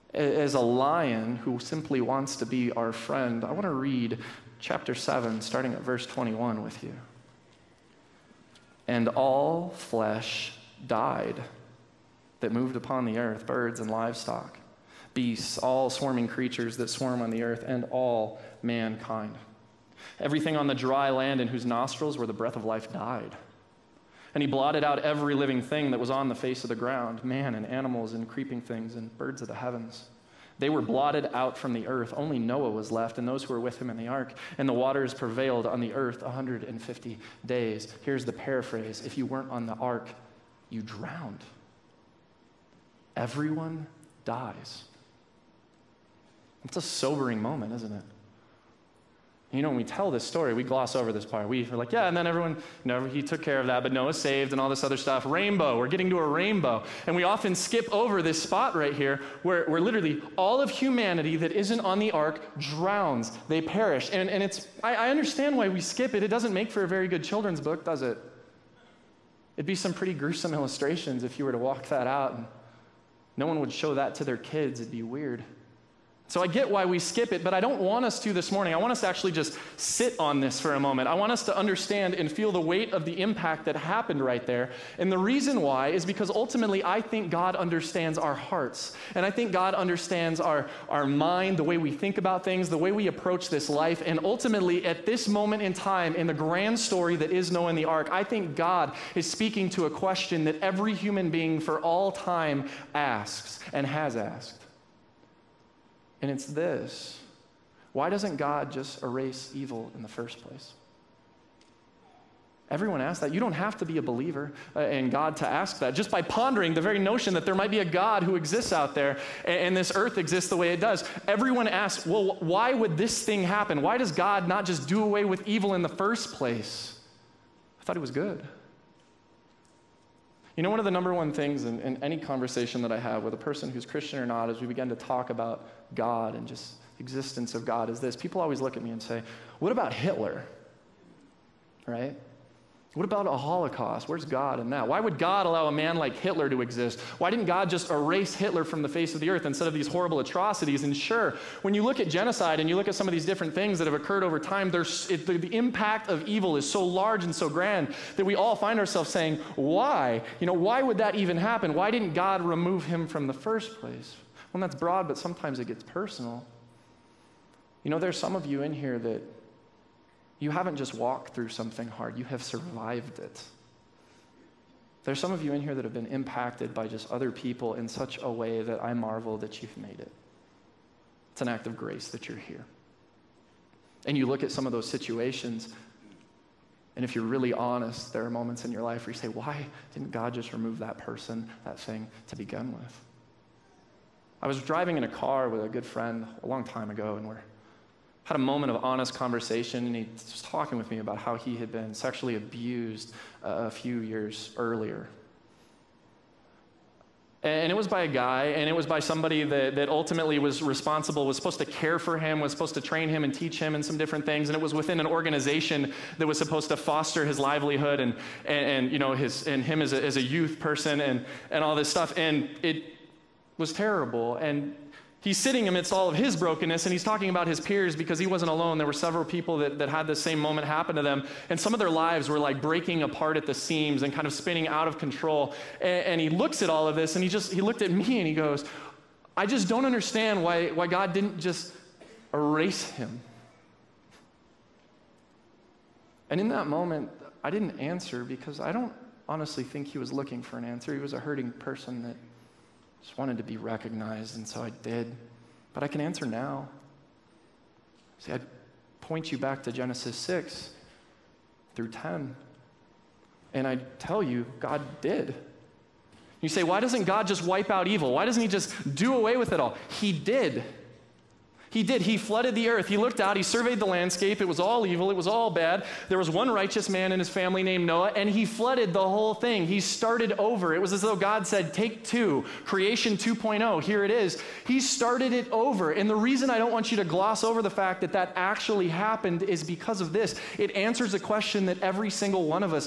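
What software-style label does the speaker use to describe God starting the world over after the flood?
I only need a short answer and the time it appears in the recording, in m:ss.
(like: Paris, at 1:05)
Creation 2.0, at 4:42.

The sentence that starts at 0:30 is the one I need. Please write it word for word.
They were blotted out from the earth.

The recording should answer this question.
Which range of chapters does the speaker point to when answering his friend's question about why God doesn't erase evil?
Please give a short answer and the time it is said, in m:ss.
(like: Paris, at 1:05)
Genesis 6 through 10, at 4:19.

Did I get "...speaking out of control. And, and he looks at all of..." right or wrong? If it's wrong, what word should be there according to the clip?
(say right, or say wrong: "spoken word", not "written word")
wrong: "spinning", not "speaking".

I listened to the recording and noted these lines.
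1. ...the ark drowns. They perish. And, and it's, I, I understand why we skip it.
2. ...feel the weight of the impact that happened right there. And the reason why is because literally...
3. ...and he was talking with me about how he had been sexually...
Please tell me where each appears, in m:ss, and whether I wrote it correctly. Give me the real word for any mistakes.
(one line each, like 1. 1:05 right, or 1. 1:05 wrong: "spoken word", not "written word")
1. 1:01 right
2. 1:22 wrong: "ultimately", not "literally"
3. 3:19 right.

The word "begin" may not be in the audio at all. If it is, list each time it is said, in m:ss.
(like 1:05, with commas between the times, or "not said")
2:14, 3:12.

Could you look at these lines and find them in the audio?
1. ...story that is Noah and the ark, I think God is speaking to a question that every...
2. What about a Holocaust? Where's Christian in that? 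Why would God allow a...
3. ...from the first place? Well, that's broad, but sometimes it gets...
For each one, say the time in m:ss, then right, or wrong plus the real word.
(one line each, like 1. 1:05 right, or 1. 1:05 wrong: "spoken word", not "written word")
1. 1:36 right
2. 2:22 wrong: "God", not "Christian"
3. 2:43 right.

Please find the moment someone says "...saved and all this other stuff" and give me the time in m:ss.
0:54.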